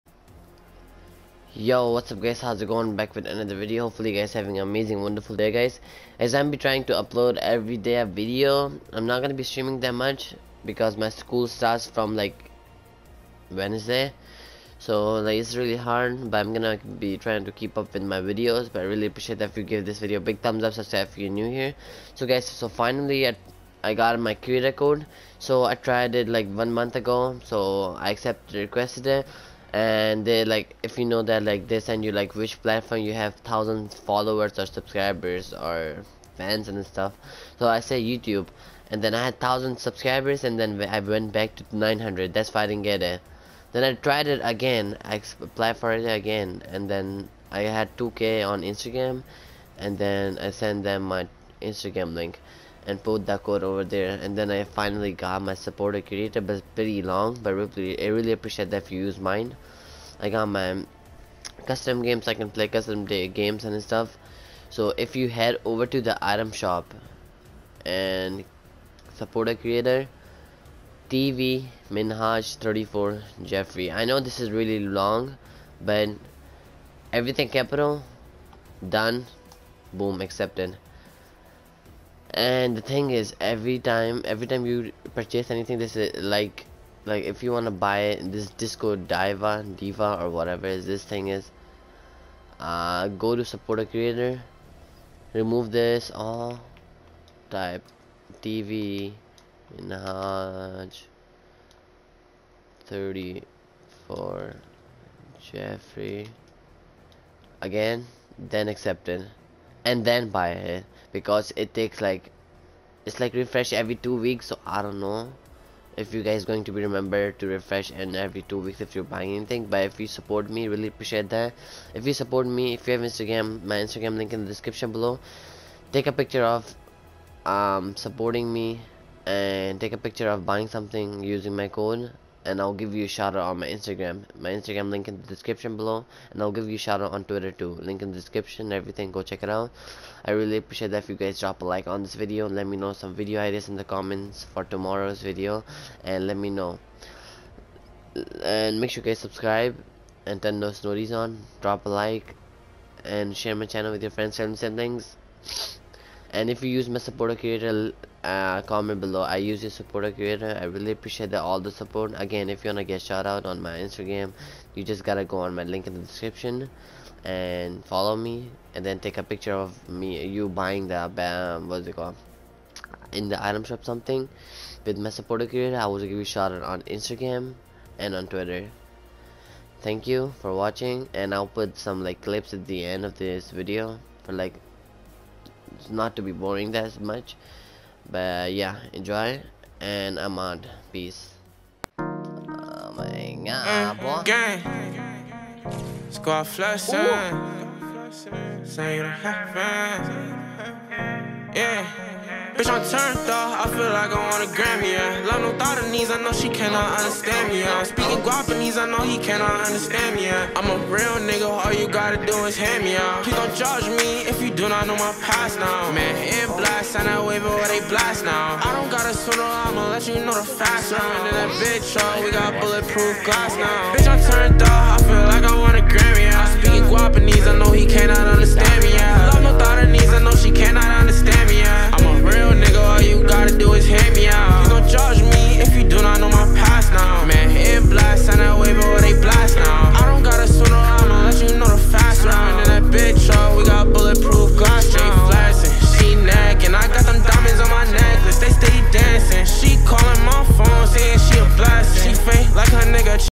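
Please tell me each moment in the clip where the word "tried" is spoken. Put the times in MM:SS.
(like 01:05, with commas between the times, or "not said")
00:25, 00:43.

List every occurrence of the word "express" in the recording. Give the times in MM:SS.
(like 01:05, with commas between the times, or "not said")
not said.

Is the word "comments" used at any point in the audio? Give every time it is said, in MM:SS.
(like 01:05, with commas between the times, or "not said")
02:23, 02:38.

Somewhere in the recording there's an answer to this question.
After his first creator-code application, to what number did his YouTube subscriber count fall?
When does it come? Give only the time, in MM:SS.
00:41.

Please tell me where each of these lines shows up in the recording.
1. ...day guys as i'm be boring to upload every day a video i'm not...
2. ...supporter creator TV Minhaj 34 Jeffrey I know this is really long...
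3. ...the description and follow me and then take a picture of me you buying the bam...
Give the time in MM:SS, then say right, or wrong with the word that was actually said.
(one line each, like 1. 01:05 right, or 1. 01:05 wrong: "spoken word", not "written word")
1. 00:05 wrong: "trying", not "boring"
2. 01:09 right
3. 02:45 right.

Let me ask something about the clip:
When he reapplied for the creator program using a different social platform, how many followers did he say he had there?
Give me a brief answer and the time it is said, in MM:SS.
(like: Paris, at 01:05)
2k, at 00:47.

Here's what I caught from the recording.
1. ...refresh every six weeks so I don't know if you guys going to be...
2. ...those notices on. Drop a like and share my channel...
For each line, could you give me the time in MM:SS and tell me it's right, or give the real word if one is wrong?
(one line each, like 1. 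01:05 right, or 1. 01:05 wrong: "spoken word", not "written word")
1. 01:53 wrong: "two", not "six"
2. 02:30 right.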